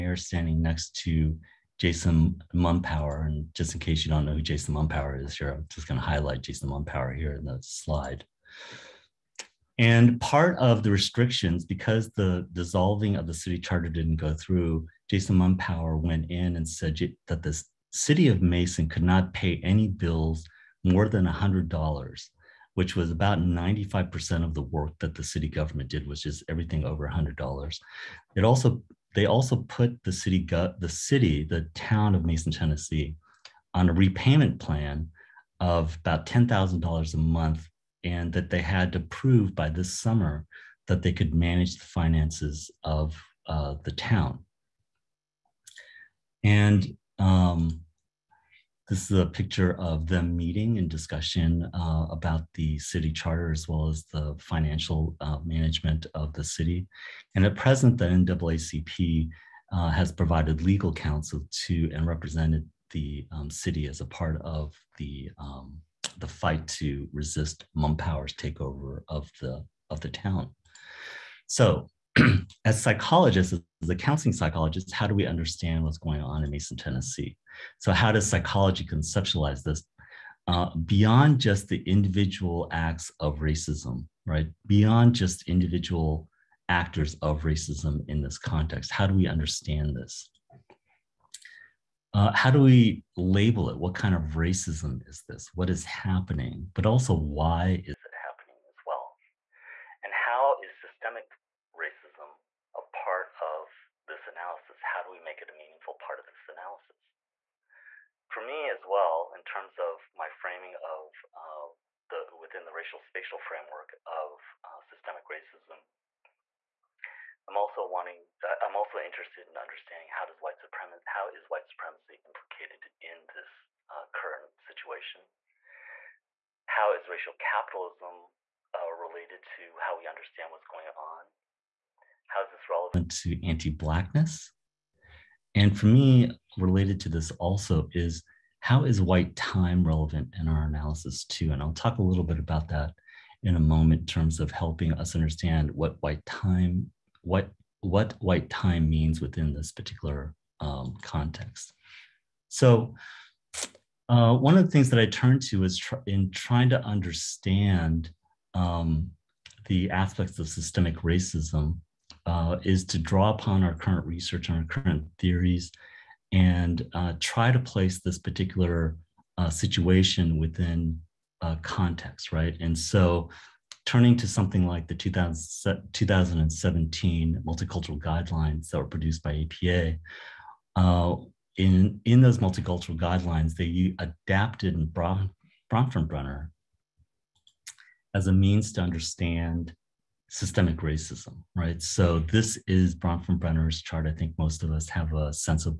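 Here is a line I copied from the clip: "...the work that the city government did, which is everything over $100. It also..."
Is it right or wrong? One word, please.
right.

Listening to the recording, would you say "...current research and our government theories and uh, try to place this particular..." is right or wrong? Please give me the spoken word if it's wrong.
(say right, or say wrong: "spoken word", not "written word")
wrong: "current", not "government".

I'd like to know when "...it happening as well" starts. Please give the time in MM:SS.
01:38.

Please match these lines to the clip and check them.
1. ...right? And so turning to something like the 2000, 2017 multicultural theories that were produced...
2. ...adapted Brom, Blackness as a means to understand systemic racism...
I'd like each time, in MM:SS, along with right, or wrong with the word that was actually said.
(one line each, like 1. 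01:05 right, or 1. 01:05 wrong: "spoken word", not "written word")
1. 02:52 wrong: "guidelines", not "theories"
2. 03:03 wrong: "Bronfenbrenner", not "Blackness".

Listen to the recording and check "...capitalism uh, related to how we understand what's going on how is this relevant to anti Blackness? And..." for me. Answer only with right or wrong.
right.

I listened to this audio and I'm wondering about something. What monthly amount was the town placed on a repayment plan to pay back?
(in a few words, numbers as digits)
$10,000.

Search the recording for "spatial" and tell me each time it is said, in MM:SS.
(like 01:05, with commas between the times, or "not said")
01:52.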